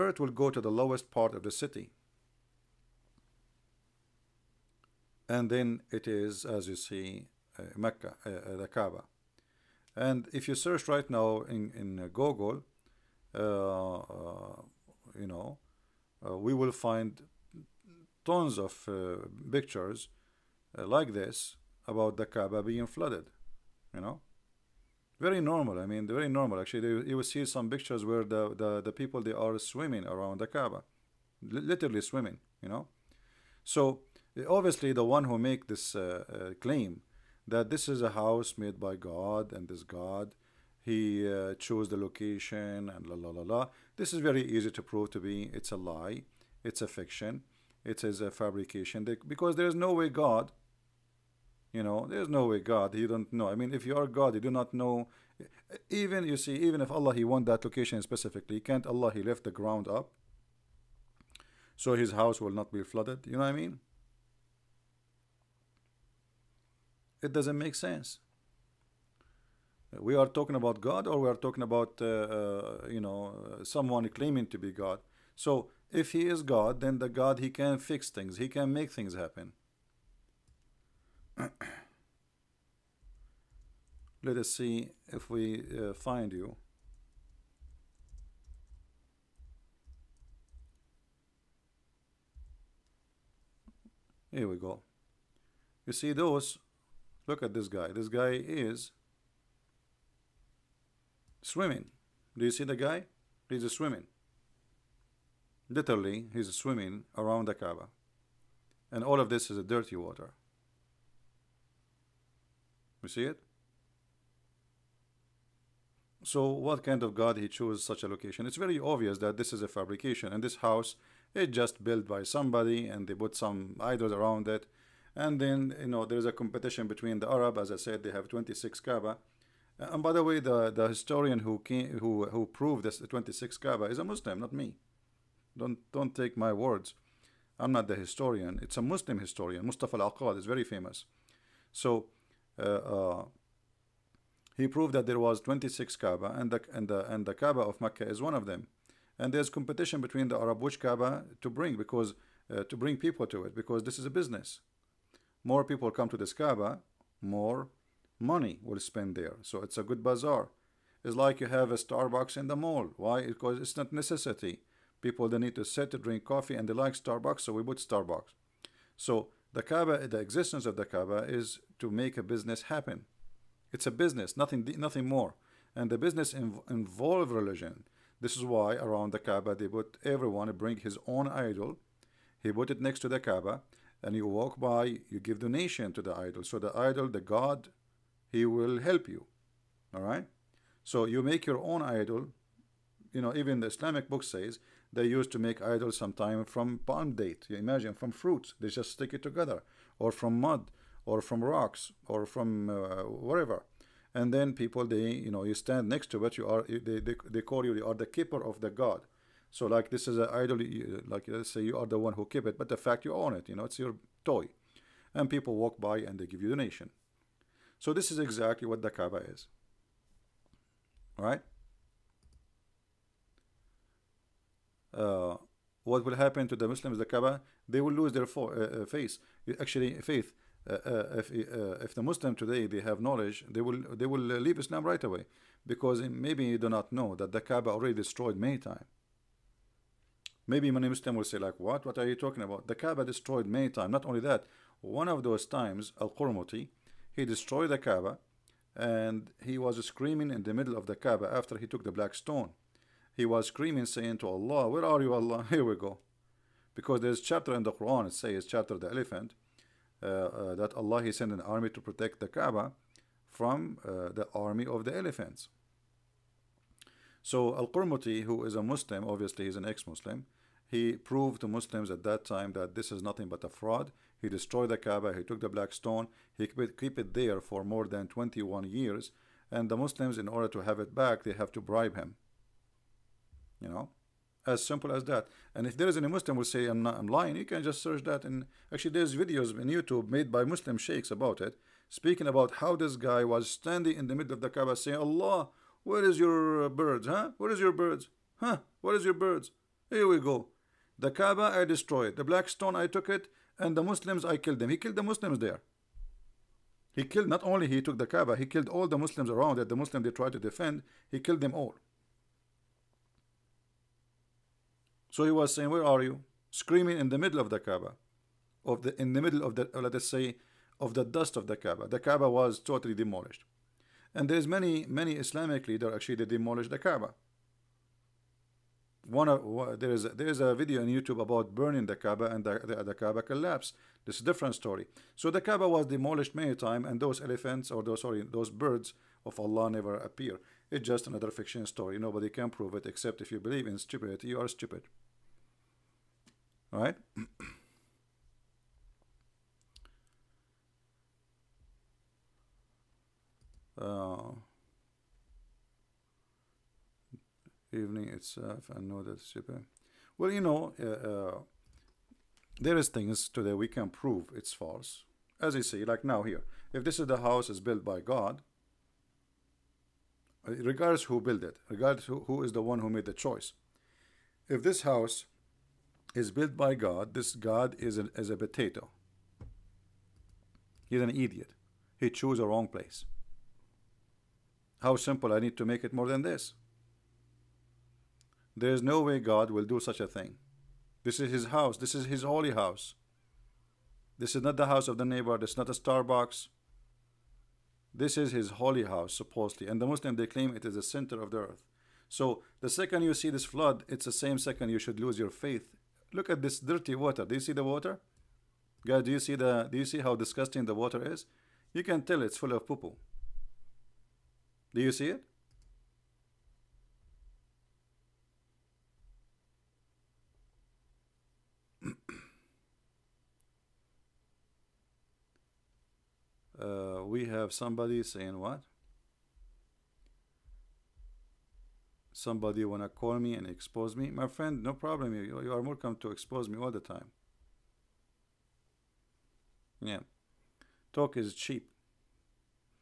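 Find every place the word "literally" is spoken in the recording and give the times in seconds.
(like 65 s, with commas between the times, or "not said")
31 s, 105 s.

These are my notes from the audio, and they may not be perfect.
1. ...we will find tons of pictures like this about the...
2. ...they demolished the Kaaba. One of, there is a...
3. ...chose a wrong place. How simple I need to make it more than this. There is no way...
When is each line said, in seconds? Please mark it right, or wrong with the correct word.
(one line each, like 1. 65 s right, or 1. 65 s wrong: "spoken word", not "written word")
1. 16 s right
2. 326 s right
3. 382 s right.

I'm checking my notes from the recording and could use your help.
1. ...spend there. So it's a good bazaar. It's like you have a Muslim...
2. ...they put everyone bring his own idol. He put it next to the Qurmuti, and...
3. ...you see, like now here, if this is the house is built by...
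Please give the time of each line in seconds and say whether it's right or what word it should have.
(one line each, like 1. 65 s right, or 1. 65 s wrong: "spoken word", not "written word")
1. 158 s wrong: "Starbucks", not "Muslim"
2. 179 s wrong: "Kaaba", not "Qurmuti"
3. 365 s right.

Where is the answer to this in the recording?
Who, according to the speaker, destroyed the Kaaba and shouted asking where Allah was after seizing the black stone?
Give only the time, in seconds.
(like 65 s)
246 s.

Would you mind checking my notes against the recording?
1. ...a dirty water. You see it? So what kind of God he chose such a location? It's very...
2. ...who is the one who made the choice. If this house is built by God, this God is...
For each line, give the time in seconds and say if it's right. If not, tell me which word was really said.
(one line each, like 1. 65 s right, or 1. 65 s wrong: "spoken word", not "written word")
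1. 109 s right
2. 372 s right.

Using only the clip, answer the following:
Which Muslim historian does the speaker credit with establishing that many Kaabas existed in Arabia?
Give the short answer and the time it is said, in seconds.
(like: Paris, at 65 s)
Mustafa al-Aqad, at 139 s.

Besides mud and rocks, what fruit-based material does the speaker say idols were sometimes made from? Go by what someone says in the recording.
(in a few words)
palm date.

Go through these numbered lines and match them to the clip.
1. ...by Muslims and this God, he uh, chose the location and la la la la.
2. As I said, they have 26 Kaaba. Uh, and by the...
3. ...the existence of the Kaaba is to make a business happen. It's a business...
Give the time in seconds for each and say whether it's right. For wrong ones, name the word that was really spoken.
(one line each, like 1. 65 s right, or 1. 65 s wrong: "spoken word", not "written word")
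1. 38 s wrong: "God", not "Muslims"
2. 127 s right
3. 170 s right.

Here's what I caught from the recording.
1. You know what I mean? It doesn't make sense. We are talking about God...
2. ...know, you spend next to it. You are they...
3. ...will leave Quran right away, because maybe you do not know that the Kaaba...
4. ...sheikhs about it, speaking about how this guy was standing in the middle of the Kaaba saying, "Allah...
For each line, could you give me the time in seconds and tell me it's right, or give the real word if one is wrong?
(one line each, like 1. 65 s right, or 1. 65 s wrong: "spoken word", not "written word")
1. 63 s right
2. 205 s wrong: "stand", not "spend"
3. 234 s wrong: "Islam", not "Quran"
4. 290 s right.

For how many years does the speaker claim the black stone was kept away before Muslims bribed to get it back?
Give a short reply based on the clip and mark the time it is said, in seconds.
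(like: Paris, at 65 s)
21, at 278 s.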